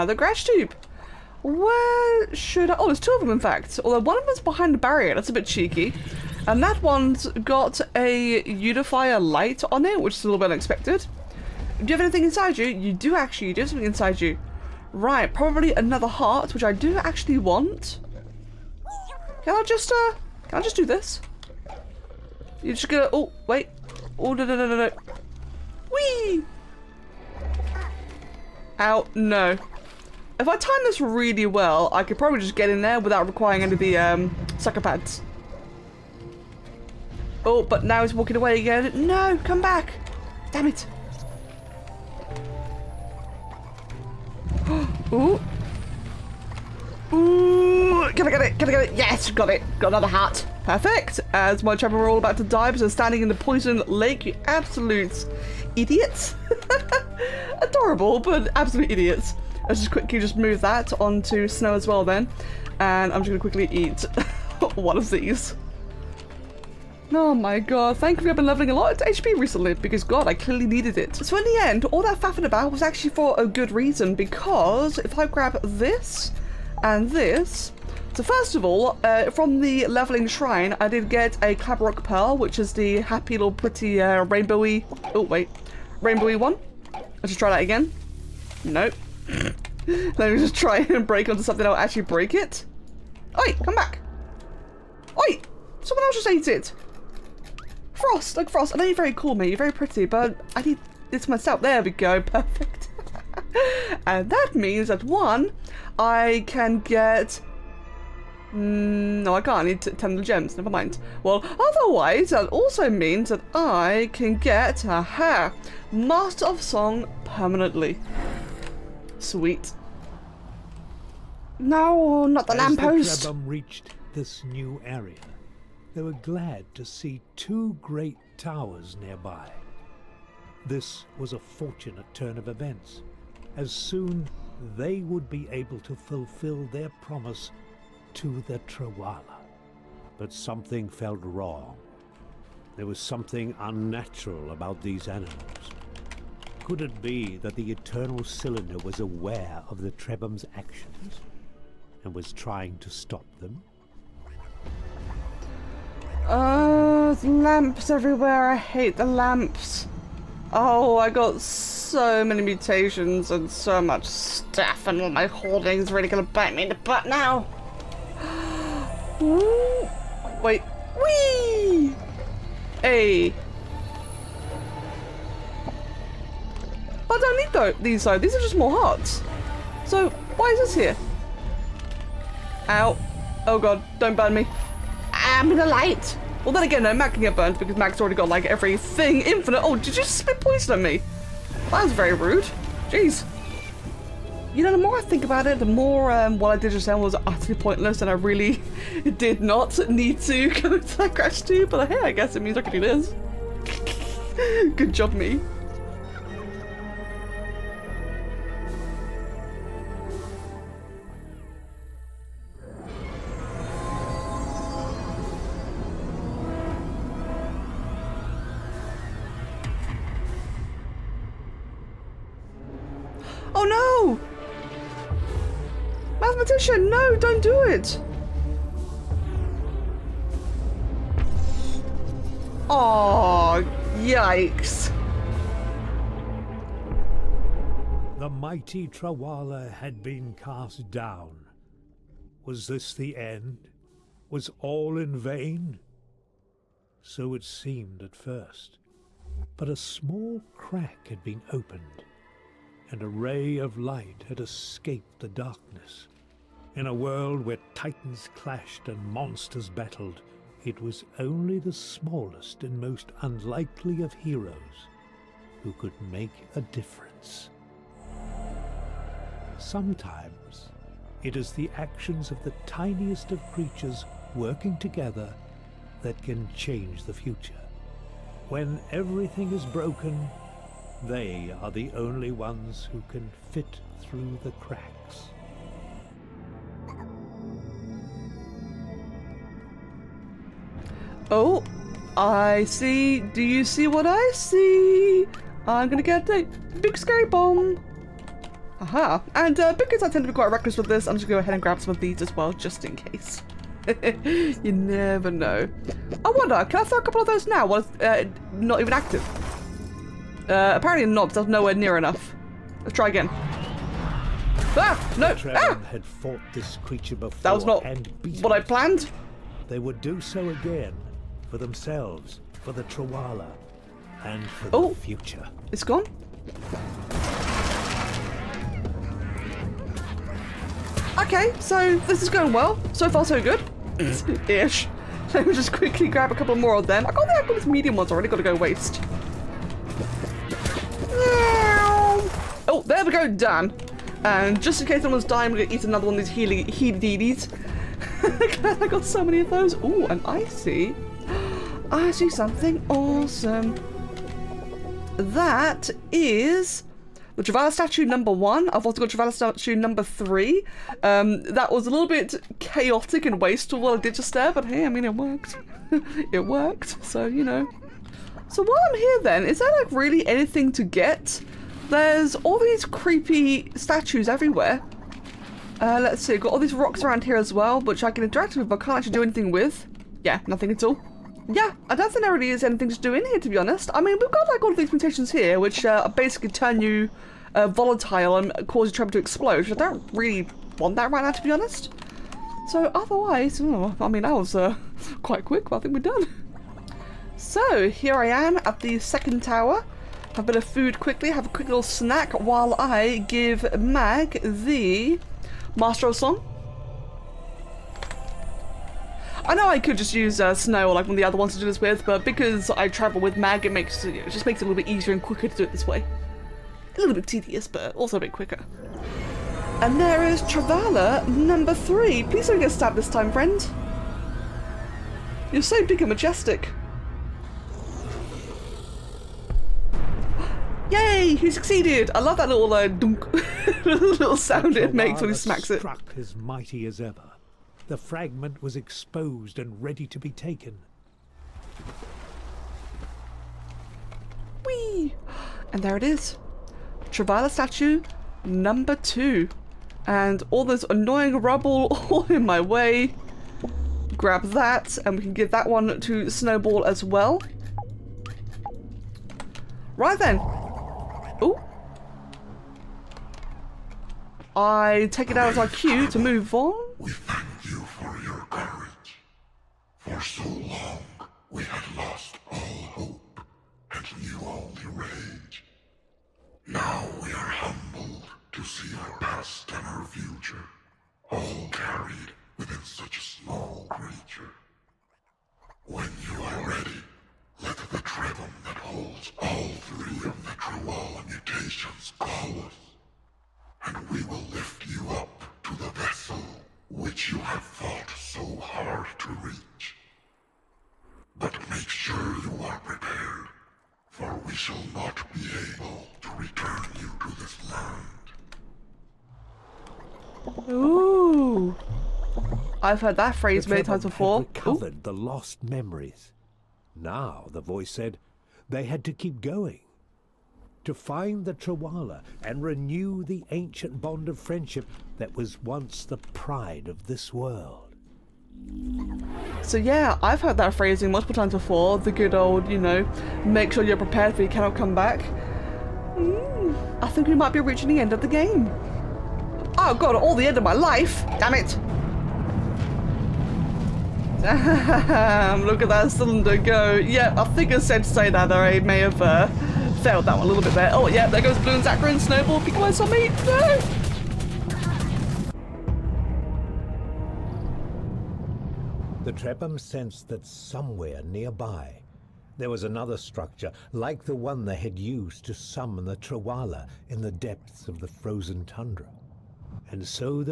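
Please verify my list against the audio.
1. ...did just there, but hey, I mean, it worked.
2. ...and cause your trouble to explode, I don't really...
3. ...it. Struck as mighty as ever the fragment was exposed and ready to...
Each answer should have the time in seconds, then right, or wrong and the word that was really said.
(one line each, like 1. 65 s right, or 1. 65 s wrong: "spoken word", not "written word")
1. 364 s right
2. 388 s right
3. 435 s right.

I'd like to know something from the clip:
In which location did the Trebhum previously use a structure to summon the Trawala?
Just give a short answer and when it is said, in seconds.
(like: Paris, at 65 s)
frozen tundra, at 568 s.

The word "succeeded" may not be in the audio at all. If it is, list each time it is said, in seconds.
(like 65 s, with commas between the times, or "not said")
431 s.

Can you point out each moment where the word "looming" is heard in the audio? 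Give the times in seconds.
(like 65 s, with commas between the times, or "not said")
not said.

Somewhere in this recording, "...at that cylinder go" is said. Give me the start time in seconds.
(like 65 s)
545 s.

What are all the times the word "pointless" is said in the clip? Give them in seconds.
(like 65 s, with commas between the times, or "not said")
197 s.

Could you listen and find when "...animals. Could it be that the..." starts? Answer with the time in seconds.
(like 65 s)
145 s.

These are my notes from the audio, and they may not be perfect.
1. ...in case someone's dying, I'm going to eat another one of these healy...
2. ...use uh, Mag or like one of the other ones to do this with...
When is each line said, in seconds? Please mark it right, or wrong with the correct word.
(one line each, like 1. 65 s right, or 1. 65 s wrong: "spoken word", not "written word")
1. 344 s wrong: "anyone", not "someone"
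2. 410 s wrong: "Snow", not "Mag".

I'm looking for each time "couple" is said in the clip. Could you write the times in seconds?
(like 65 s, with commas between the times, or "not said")
307 s, 336 s.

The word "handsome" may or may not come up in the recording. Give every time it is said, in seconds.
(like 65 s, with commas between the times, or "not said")
not said.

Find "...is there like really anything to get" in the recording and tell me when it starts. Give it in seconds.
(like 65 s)
369 s.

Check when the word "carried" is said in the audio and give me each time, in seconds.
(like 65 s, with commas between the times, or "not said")
481 s.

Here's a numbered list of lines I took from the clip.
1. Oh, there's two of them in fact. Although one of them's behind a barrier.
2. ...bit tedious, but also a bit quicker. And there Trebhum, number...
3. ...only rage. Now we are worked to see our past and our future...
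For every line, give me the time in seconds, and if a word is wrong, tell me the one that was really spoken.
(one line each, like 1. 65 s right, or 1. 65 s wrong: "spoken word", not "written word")
1. 2 s right
2. 417 s wrong: "Travala", not "Trebhum"
3. 474 s wrong: "humbled", not "worked".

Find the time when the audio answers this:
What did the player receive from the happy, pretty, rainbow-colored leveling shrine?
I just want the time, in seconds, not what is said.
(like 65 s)
81 s.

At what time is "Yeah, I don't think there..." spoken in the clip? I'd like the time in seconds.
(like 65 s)
381 s.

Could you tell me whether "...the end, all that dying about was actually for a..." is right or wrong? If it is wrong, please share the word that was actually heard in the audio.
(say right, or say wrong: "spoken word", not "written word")
wrong: "faffing", not "dying".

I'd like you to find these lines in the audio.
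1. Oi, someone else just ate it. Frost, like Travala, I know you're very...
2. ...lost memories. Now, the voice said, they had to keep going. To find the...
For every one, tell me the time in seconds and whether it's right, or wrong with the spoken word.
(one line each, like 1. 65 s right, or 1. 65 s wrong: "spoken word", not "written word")
1. 95 s wrong: "Frost", not "Travala"
2. 515 s right.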